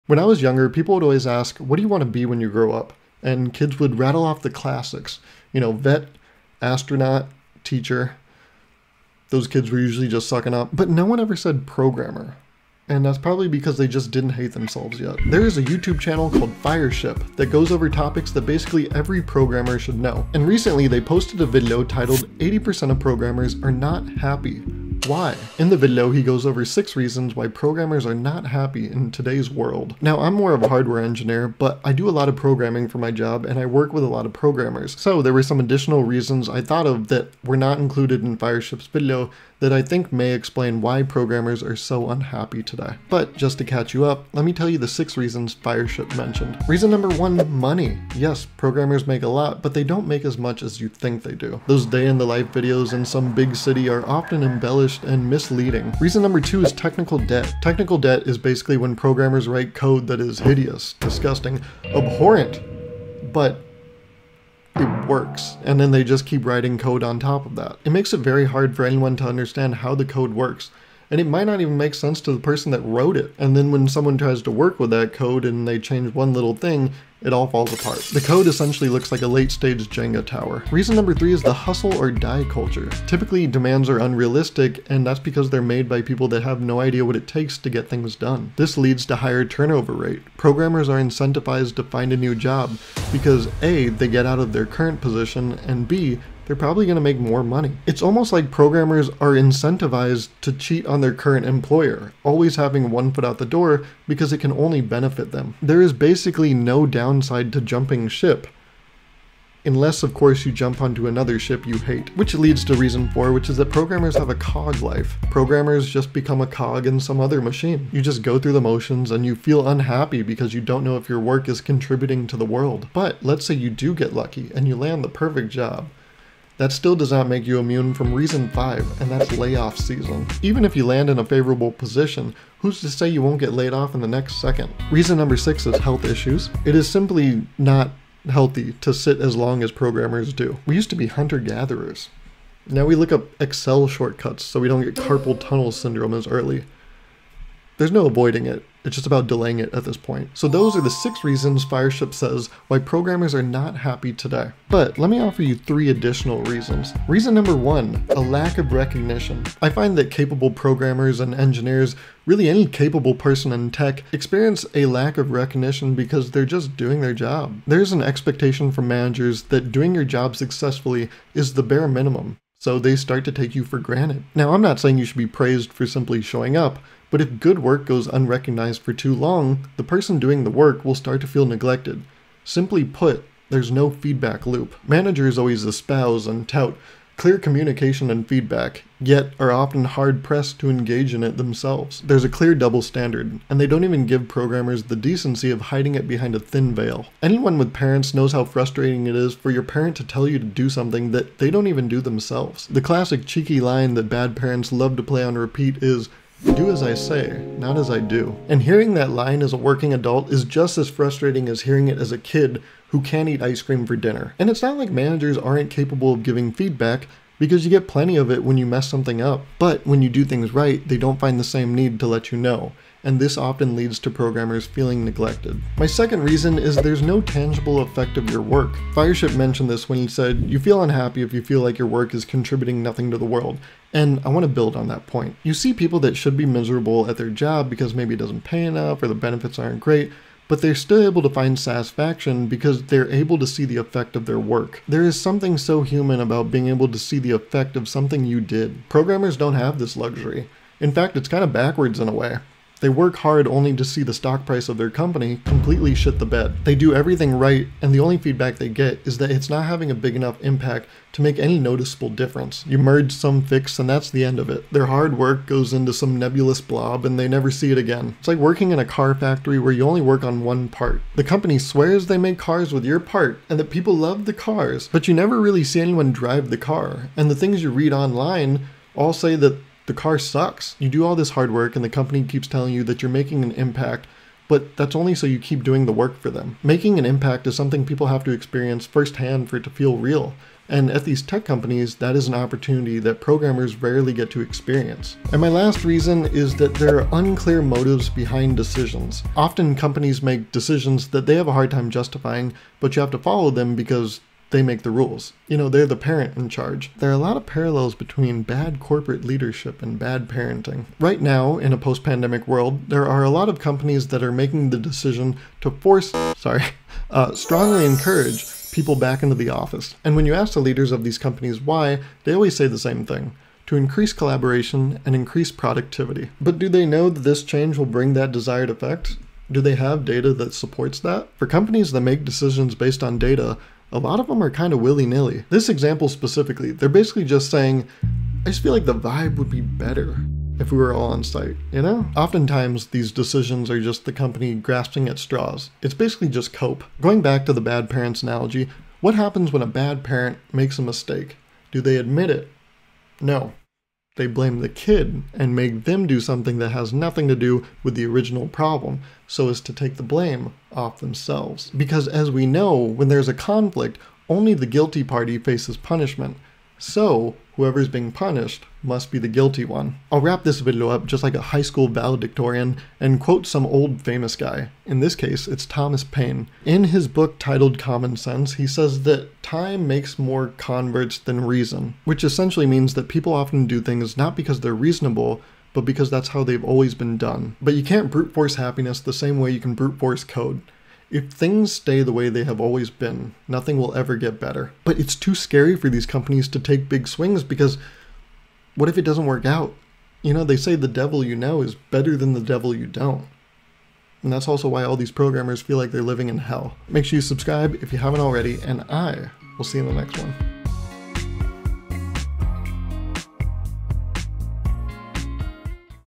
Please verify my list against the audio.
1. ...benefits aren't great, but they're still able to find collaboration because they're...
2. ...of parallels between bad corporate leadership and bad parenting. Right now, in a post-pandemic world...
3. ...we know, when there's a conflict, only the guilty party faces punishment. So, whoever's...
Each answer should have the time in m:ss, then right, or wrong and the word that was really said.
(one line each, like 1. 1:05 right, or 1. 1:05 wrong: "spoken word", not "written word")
1. 3:59 wrong: "satisfaction", not "collaboration"
2. 5:07 right
3. 6:02 right.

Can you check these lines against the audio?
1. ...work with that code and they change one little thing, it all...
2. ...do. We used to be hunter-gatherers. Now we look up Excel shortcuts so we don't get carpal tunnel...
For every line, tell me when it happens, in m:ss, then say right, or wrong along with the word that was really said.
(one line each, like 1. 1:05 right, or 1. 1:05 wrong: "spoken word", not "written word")
1. 1:14 right
2. 2:20 right.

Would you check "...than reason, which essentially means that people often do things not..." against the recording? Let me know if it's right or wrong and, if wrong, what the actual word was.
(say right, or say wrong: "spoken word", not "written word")
right.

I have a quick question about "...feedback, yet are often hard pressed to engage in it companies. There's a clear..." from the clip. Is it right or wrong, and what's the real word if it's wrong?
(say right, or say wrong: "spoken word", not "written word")
wrong: "themselves", not "companies".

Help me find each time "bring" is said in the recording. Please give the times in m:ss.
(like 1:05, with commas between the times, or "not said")
5:27.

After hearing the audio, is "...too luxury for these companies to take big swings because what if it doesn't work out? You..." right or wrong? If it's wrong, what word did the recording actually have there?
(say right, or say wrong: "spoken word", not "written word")
wrong: "scary", not "luxury".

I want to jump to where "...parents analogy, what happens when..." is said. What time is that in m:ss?
5:47.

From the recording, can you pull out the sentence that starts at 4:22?
You merge some fix, and that's the end of it.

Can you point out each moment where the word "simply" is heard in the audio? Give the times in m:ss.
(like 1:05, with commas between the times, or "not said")
2:16, 2:55, 3:02.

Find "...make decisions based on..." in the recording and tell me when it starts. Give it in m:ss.
5:32.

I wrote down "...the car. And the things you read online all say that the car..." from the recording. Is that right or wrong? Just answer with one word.
right.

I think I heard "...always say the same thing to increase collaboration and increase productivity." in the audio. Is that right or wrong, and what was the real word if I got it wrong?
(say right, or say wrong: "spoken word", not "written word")
right.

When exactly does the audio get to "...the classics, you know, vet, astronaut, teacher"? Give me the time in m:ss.
0:04.